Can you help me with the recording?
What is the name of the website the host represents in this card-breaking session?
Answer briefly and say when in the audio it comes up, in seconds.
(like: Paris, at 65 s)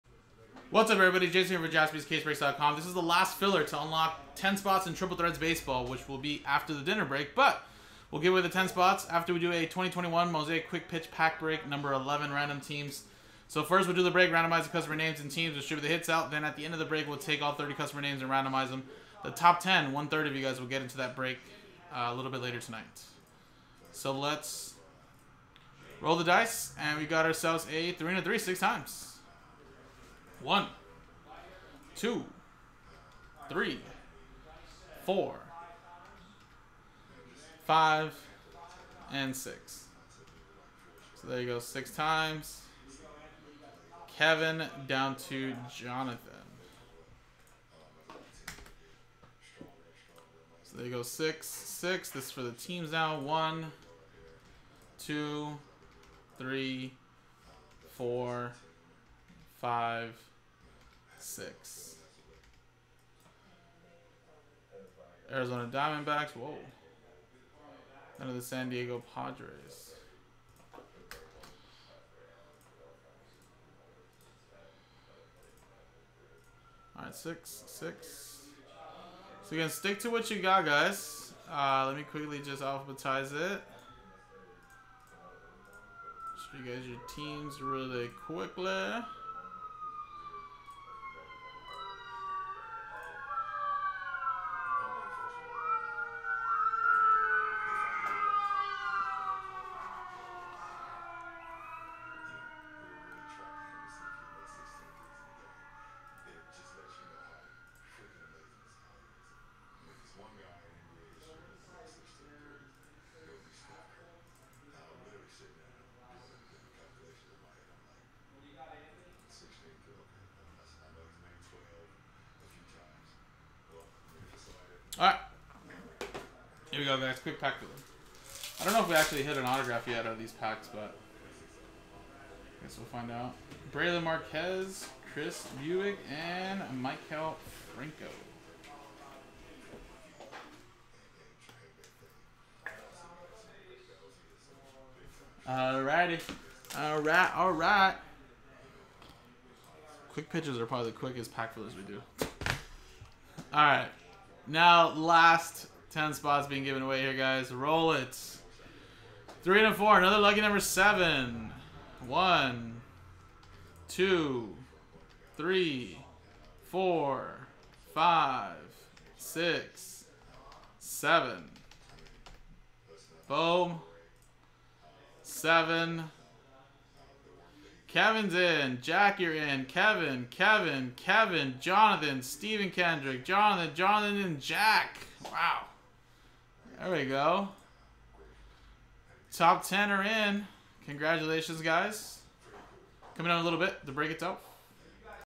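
jaspyscasebreaks.com, at 1 s.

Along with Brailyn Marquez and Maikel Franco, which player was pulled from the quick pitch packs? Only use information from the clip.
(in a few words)
Kris Bubic.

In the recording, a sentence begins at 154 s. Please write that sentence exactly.
Now, last 10 spots being given away here, guys.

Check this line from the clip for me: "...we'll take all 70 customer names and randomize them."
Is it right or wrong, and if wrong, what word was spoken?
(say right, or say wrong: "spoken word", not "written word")
wrong: "30", not "70".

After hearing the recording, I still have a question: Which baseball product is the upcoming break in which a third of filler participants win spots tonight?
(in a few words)
Triple Threads Baseball.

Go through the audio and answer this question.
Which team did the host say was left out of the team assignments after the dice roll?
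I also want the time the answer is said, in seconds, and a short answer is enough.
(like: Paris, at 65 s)
San Diego Padres, at 68 s.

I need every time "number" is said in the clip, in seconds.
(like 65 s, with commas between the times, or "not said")
11 s, 160 s.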